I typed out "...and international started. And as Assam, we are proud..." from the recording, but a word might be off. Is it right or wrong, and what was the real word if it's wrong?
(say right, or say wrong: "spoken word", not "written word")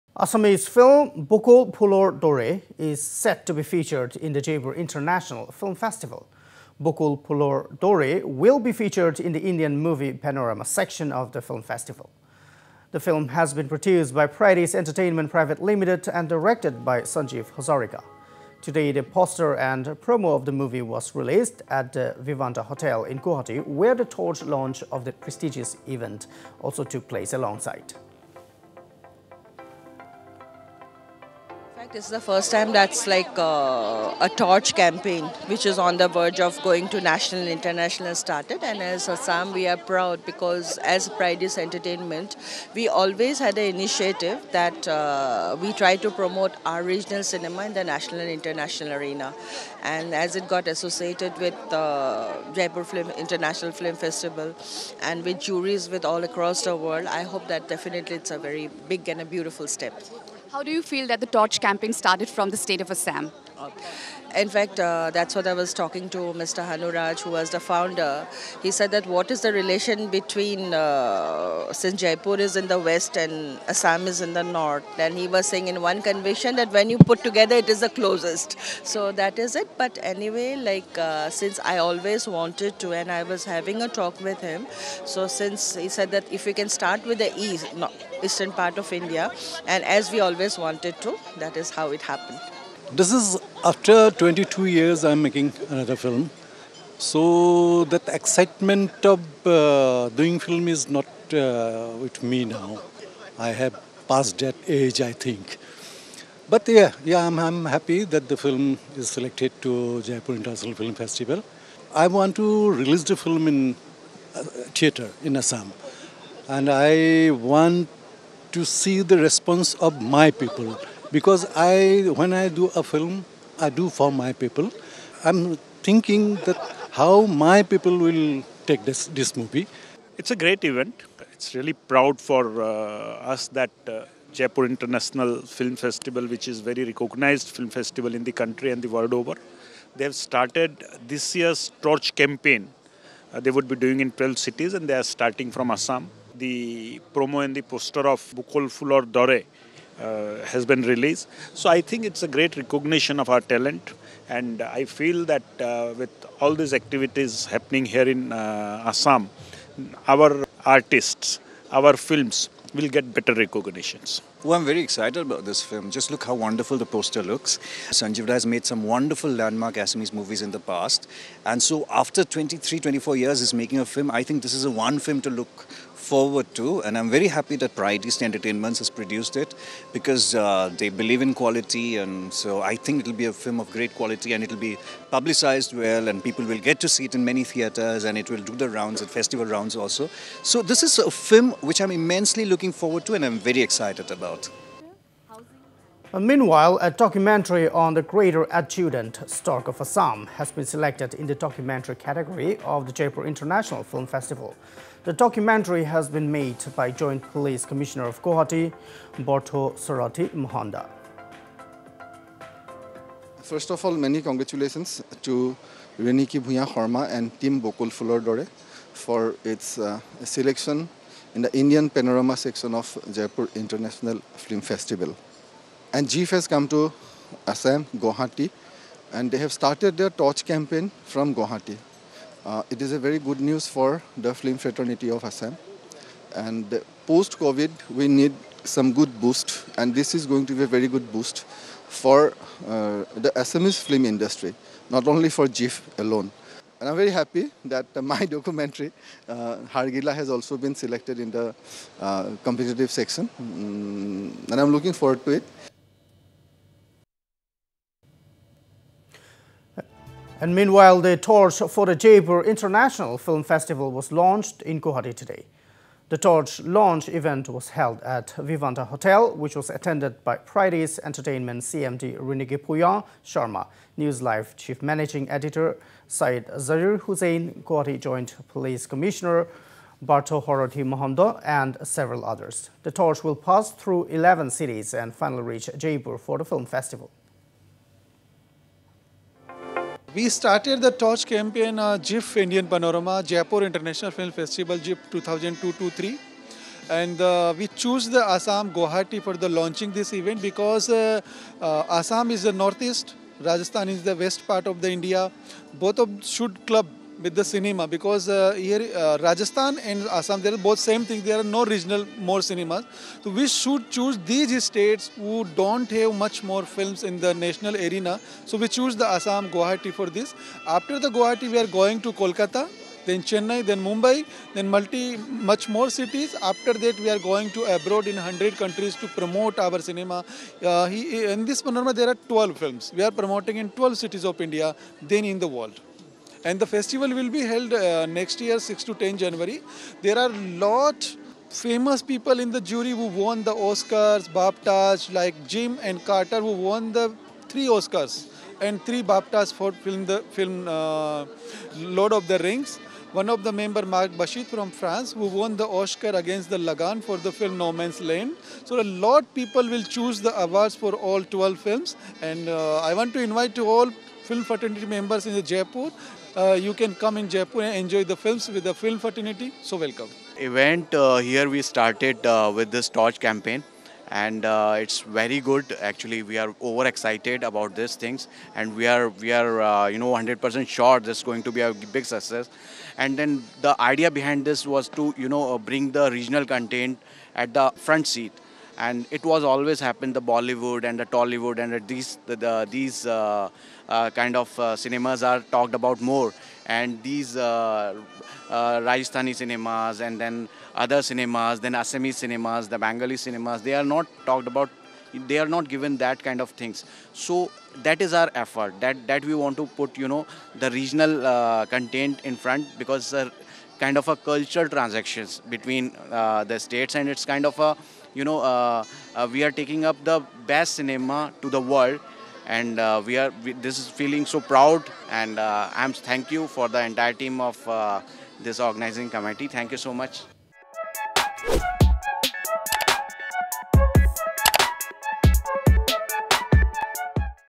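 right.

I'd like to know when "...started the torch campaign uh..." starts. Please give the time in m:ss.
4:50.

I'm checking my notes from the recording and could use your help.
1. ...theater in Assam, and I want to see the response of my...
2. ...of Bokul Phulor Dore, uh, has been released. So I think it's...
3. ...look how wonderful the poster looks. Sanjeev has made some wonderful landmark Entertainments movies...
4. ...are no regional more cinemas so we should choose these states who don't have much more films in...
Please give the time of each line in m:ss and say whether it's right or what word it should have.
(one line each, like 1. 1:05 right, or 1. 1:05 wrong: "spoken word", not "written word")
1. 1:54 right
2. 2:28 right
3. 2:46 wrong: "Assamese", not "Entertainments"
4. 5:11 right.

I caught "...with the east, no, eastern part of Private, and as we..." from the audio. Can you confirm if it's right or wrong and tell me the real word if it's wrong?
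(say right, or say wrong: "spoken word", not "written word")
wrong: "India", not "Private".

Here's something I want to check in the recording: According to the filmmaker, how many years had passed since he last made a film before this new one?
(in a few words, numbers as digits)
22.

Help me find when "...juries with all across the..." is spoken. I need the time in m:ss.
0:55.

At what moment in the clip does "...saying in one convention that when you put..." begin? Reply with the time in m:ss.
1:15.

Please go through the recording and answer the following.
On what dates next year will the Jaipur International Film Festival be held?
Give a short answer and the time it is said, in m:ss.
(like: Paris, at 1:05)
6 to 10 January, at 5:38.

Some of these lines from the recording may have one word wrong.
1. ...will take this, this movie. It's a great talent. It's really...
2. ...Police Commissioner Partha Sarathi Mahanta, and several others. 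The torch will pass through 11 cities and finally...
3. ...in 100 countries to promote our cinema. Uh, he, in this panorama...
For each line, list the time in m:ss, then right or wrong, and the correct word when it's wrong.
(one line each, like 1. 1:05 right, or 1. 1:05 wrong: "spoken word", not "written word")
1. 2:07 wrong: "event", not "talent"
2. 4:38 right
3. 5:28 right.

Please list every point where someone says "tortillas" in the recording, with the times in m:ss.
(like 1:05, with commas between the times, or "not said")
not said.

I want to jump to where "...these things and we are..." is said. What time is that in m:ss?
6:17.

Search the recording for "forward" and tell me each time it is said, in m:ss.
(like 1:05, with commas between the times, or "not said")
2:56, 3:12, 4:14.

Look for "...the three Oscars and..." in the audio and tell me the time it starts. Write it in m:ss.
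5:46.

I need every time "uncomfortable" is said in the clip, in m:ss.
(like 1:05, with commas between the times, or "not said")
not said.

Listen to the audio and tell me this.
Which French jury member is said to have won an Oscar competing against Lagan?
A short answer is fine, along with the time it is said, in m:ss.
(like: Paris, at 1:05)
Marc Baschet, at 5:53.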